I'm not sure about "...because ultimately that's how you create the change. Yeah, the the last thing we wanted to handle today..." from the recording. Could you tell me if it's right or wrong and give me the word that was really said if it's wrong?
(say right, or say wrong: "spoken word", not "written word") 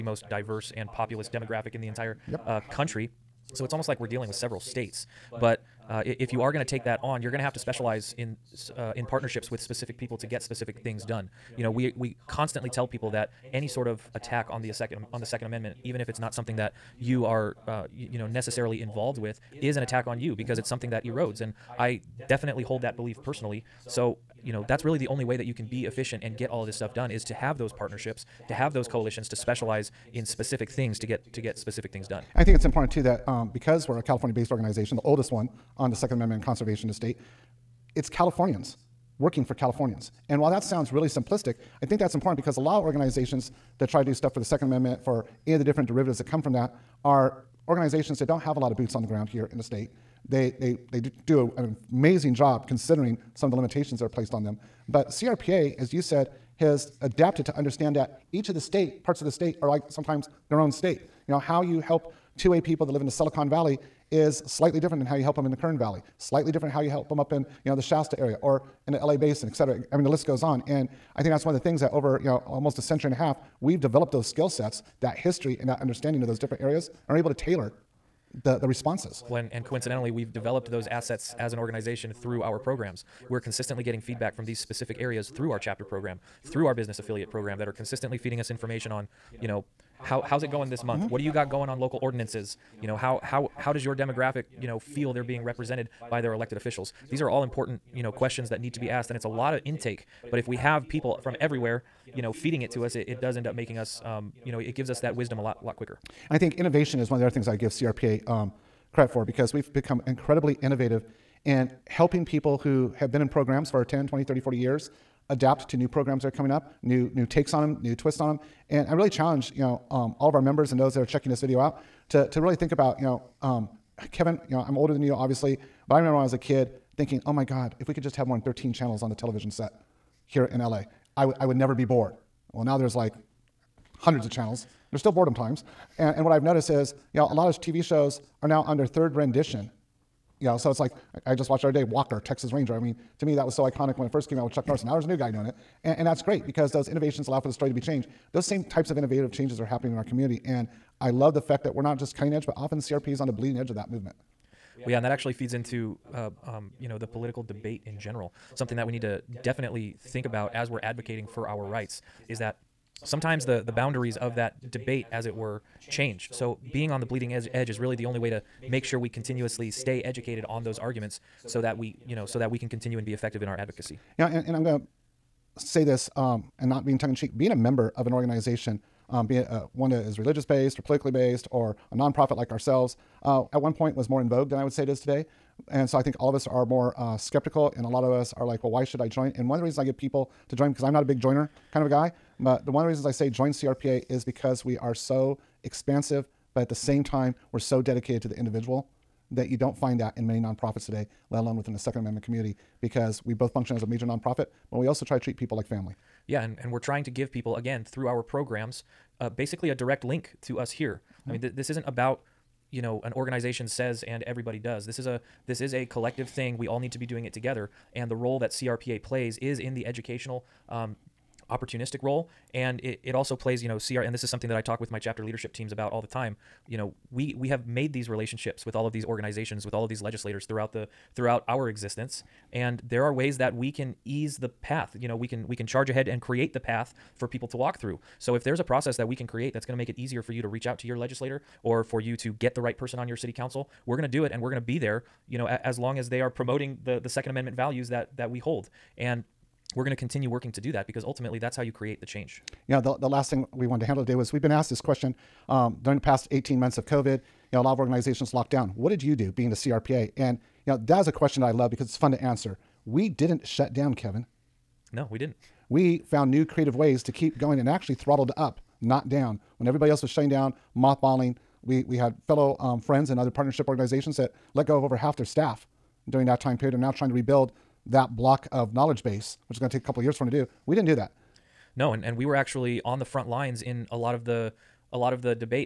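right.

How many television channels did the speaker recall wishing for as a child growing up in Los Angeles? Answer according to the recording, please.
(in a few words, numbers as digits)
13.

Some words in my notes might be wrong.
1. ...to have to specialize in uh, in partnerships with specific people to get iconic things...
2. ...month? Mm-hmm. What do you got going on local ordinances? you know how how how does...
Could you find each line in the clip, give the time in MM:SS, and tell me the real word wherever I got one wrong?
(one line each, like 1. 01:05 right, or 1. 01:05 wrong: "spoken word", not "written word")
1. 00:07 wrong: "specific", not "iconic"
2. 01:30 right.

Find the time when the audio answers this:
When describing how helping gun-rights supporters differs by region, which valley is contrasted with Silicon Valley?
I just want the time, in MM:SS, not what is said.
01:05.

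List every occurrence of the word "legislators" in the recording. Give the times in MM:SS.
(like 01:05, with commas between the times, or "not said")
03:49, 04:00.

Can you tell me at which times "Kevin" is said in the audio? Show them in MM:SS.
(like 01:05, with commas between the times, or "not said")
02:04, 04:23.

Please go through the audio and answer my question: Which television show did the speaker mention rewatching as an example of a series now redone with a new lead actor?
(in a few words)
Walker, Texas Ranger.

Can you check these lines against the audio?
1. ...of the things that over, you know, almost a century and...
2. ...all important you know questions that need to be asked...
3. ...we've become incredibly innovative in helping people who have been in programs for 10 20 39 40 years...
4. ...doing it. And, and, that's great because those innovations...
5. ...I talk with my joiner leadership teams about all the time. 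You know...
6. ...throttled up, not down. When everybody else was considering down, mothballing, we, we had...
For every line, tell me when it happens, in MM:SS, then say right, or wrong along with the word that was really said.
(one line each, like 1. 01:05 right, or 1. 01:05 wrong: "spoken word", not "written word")
1. 01:11 right
2. 01:37 right
3. 01:49 wrong: "30", not "39"
4. 02:25 right
5. 03:44 wrong: "chapter", not "joiner"
6. 04:27 wrong: "shutting", not "considering".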